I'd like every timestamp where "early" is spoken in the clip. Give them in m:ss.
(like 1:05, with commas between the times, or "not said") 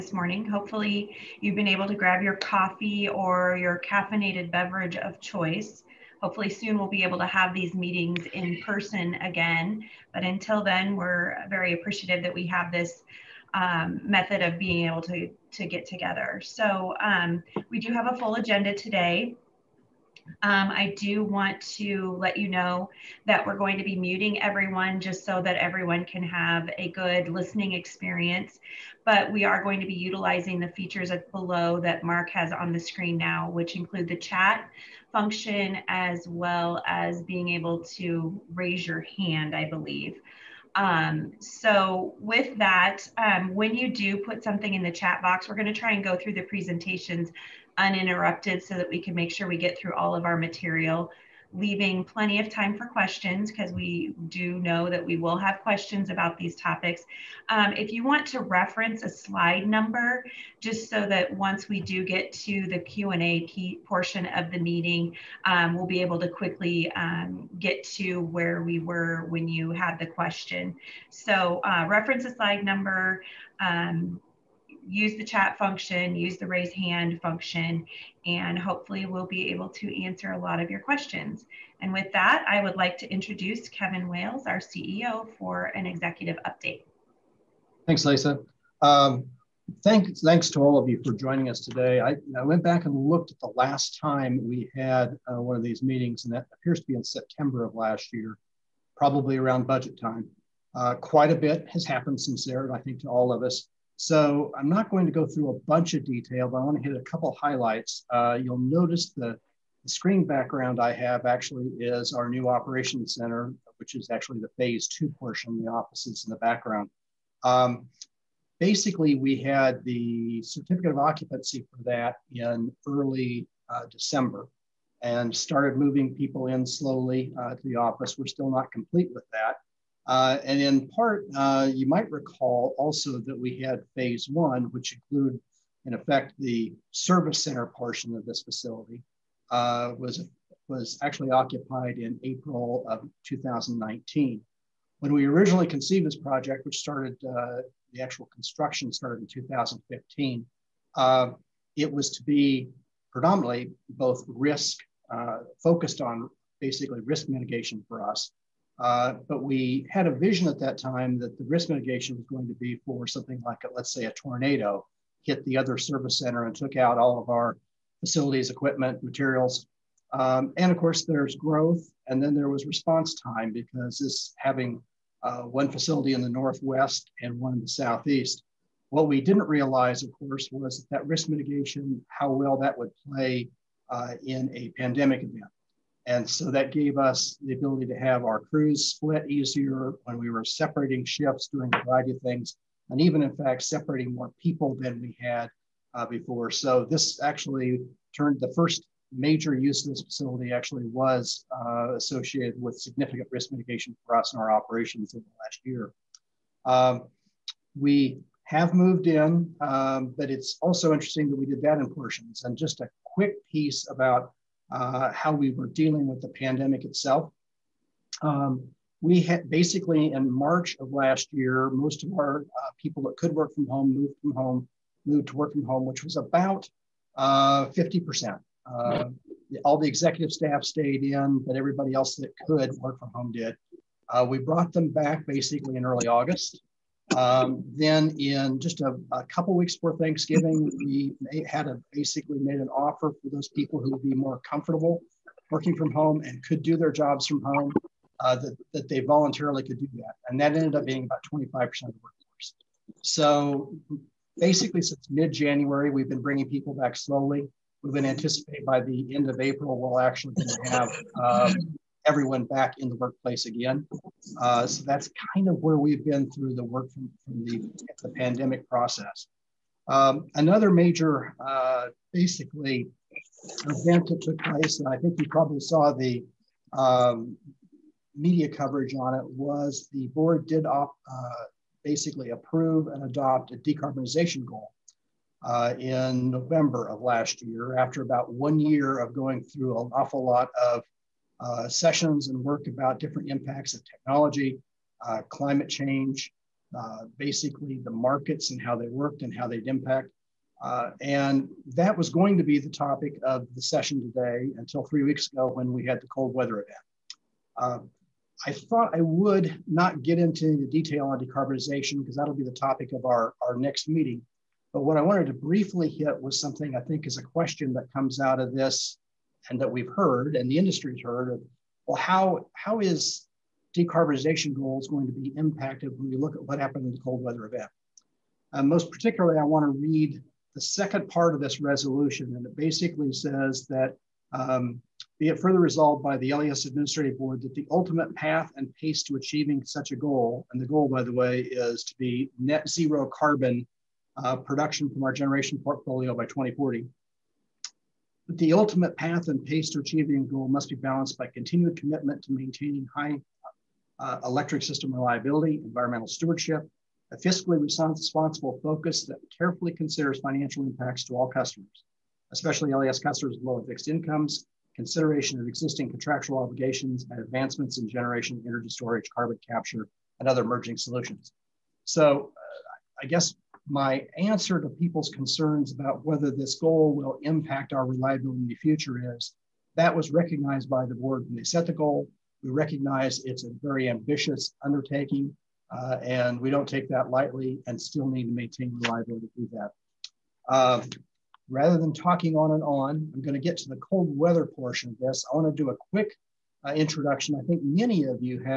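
2:02, 3:55.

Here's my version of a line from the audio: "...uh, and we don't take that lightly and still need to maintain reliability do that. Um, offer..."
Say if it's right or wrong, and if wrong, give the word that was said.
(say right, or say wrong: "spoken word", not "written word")
wrong: "rather", not "offer".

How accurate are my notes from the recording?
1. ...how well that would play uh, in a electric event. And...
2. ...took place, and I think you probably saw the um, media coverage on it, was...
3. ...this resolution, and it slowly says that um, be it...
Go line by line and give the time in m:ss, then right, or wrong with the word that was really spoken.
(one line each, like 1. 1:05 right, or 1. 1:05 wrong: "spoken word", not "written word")
1. 3:02 wrong: "pandemic", not "electric"
2. 4:34 right
3. 5:31 wrong: "basically", not "slowly".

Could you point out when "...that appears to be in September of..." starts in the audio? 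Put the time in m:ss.
1:36.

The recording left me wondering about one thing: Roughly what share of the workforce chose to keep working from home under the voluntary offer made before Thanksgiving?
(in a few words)
25%.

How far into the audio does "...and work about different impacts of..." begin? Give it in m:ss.
4:52.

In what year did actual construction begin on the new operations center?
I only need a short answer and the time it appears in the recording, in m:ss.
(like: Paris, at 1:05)
2015, at 2:29.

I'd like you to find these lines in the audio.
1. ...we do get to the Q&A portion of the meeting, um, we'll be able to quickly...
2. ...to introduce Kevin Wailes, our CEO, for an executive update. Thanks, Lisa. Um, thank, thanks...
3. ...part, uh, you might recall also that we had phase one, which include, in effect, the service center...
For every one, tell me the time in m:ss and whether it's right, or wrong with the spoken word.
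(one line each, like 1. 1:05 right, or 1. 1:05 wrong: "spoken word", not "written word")
1. 1:01 right
2. 1:22 right
3. 2:10 right.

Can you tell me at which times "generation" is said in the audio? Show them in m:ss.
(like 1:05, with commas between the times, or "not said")
5:45, 6:07.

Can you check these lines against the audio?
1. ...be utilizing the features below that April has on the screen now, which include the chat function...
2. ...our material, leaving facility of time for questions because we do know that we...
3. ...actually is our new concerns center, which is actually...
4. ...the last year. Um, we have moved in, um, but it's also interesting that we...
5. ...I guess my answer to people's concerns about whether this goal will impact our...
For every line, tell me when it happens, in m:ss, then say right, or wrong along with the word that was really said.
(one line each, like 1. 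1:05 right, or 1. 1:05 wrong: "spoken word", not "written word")
1. 0:29 wrong: "Mark", not "April"
2. 0:50 wrong: "plenty", not "facility"
3. 1:51 wrong: "operations", not "concerns"
4. 3:25 right
5. 6:13 right.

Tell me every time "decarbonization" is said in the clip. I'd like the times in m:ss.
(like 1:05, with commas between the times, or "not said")
4:43, 5:11, 5:23.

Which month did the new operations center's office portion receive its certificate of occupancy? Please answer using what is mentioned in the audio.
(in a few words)
December.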